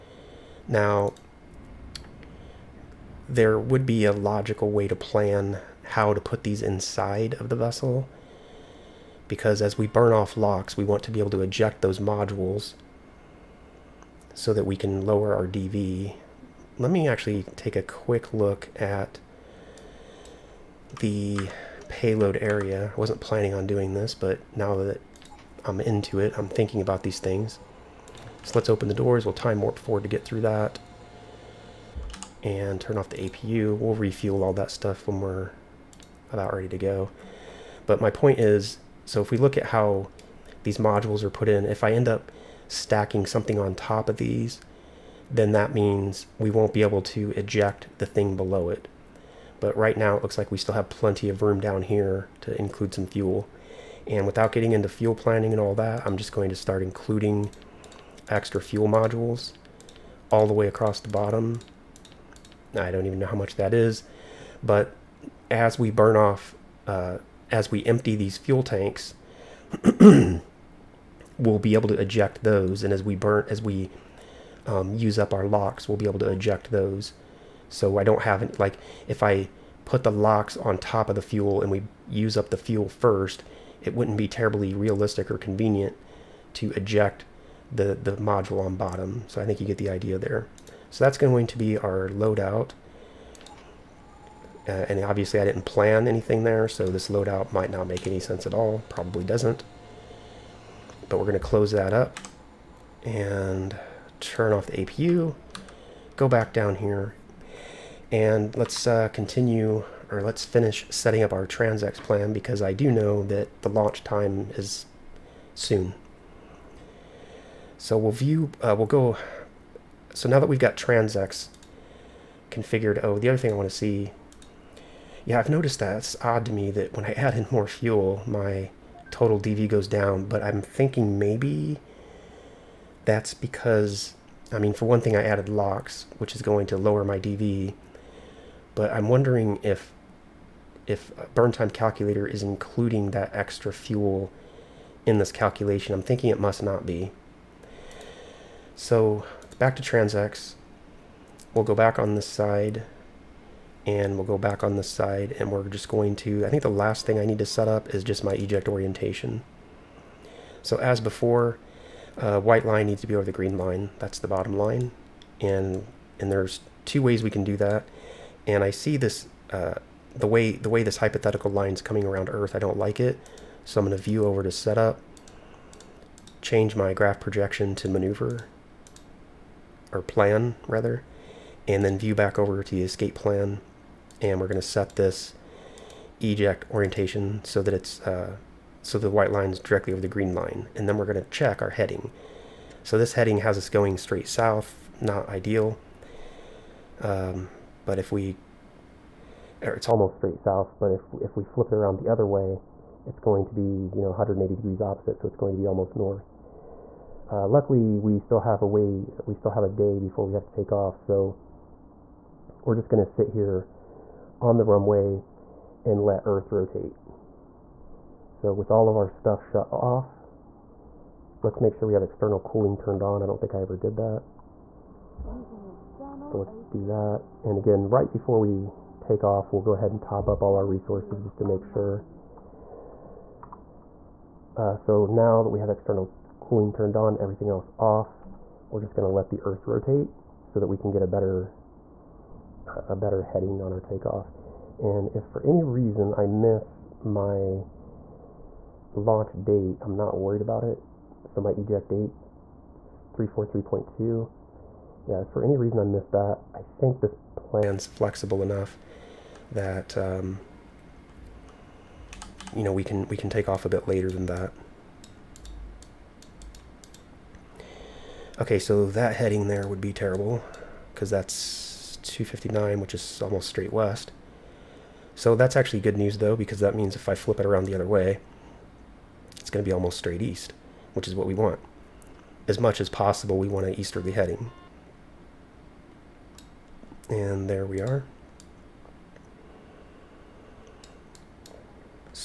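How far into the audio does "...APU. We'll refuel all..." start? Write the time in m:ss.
0:33.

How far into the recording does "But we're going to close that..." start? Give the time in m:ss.
1:41.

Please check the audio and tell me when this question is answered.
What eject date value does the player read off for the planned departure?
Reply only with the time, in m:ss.
4:13.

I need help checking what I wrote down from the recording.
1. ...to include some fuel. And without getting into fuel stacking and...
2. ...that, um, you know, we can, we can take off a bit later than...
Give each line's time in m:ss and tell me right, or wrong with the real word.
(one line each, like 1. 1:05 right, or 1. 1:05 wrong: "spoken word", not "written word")
1. 0:52 wrong: "planning", not "stacking"
2. 4:19 right.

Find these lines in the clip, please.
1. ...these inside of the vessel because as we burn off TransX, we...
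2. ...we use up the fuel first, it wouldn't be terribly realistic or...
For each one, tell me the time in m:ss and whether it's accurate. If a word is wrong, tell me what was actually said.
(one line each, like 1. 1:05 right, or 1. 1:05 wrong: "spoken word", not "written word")
1. 0:06 wrong: "LOX", not "TransX"
2. 1:21 right.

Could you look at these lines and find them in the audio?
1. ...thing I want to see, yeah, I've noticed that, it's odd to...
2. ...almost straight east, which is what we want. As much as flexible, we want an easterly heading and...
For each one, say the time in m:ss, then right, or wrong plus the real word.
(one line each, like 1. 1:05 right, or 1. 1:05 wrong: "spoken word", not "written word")
1. 2:03 right
2. 4:39 wrong: "possible", not "flexible".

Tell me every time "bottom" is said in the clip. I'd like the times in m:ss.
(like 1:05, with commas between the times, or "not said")
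1:01, 1:28, 2:44.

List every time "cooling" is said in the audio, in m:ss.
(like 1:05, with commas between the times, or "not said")
3:42, 3:56.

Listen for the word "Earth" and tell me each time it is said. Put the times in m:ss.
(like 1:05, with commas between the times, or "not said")
2:52, 3:36, 3:59.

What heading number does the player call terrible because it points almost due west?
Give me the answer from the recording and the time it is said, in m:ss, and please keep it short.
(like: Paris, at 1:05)
259, at 4:32.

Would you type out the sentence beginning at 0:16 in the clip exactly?
Let me actually take a quick look at the payload area.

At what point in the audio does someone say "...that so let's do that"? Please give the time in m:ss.
3:43.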